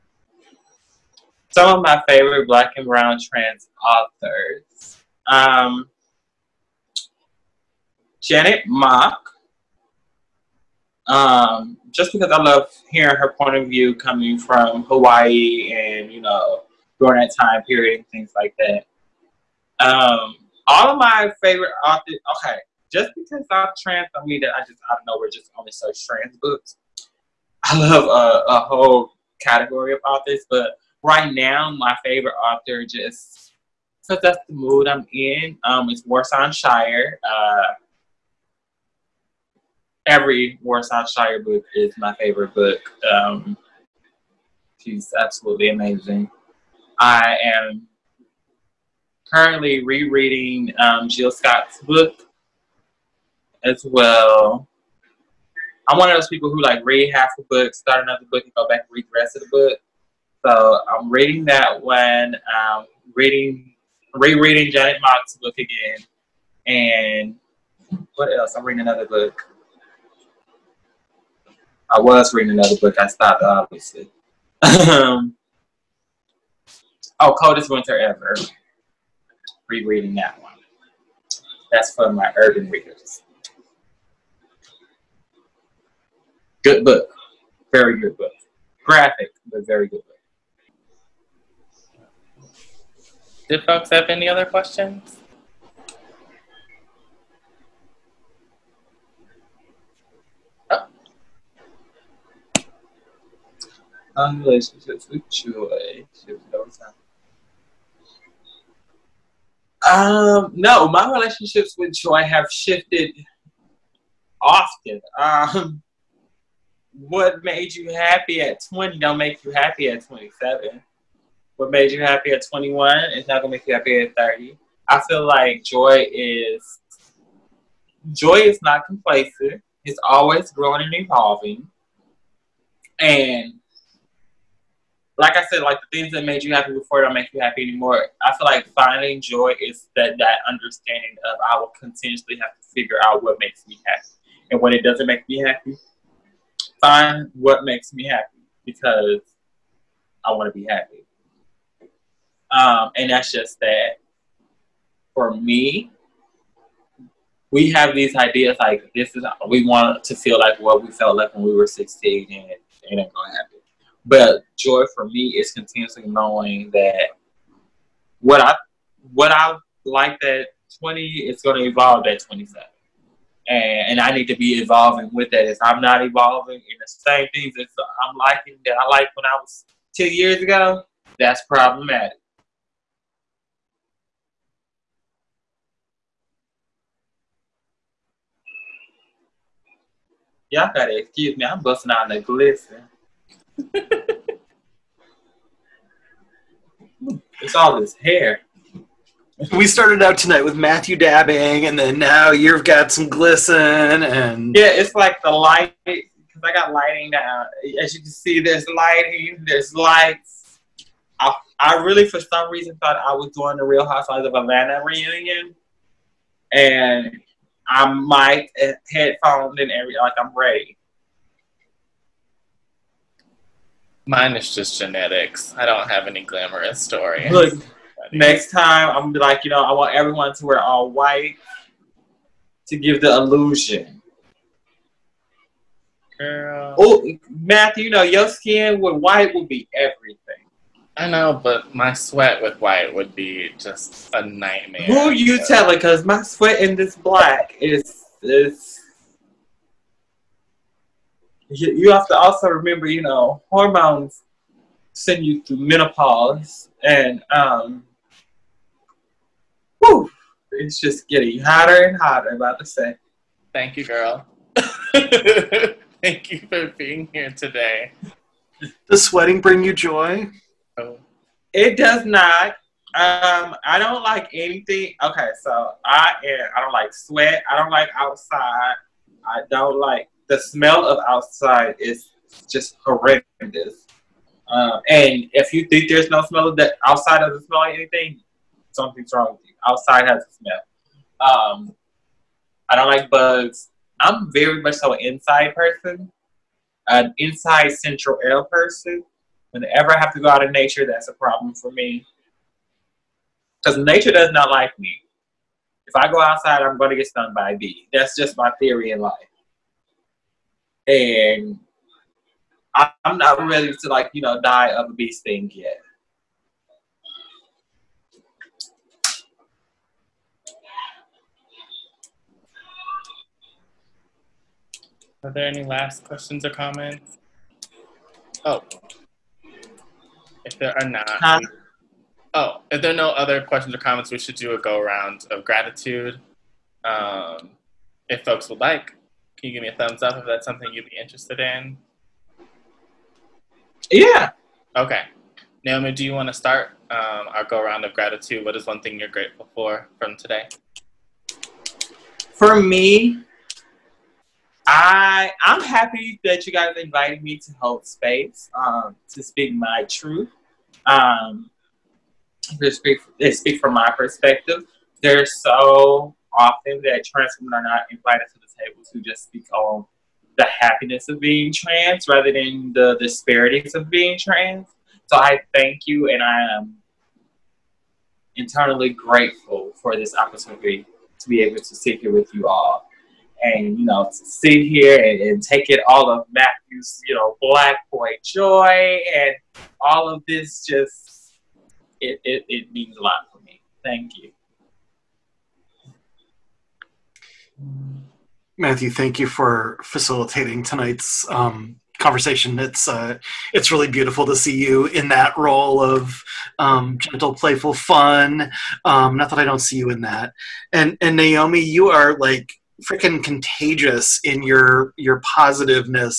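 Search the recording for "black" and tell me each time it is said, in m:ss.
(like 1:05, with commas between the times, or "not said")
0:02, 4:06, 6:27.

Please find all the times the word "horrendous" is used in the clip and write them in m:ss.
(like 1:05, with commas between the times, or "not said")
4:42.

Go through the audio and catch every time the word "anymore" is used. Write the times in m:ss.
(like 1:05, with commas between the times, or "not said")
2:17.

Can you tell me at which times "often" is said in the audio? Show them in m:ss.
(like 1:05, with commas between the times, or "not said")
1:54, 6:06.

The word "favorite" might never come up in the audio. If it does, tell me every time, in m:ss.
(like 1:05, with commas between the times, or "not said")
0:02, 0:21, 0:32, 0:42.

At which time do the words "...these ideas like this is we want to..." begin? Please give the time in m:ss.
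2:37.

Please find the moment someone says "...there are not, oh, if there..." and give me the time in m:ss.
5:30.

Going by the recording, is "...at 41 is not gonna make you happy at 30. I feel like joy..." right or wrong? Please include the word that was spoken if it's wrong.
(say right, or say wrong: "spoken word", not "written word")
wrong: "21", not "41".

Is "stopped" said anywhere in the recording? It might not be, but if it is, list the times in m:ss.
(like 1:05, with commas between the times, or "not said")
1:13.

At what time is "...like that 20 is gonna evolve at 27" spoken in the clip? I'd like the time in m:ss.
2:49.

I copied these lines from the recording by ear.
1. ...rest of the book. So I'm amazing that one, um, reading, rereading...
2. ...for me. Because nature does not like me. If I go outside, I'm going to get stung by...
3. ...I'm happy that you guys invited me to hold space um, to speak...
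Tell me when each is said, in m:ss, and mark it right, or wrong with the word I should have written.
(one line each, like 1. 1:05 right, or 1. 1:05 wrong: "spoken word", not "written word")
1. 0:59 wrong: "reading", not "amazing"
2. 5:01 right
3. 5:55 right.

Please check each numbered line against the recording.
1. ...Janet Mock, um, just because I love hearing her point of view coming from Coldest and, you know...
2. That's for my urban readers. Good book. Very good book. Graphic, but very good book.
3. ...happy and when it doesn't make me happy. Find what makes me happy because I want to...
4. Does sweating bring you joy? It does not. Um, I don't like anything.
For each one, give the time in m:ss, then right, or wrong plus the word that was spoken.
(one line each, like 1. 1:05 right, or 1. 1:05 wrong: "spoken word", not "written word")
1. 0:08 wrong: "Hawaii", not "Coldest"
2. 1:21 right
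3. 2:23 right
4. 4:28 right.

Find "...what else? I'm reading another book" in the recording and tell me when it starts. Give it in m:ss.
1:08.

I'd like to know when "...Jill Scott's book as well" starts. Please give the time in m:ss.
0:51.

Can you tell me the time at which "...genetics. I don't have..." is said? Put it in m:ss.
3:44.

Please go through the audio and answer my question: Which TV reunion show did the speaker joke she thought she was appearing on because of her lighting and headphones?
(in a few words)
Real Housewives of Atlanta.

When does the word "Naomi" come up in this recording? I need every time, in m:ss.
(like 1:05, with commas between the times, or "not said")
5:45, 6:51.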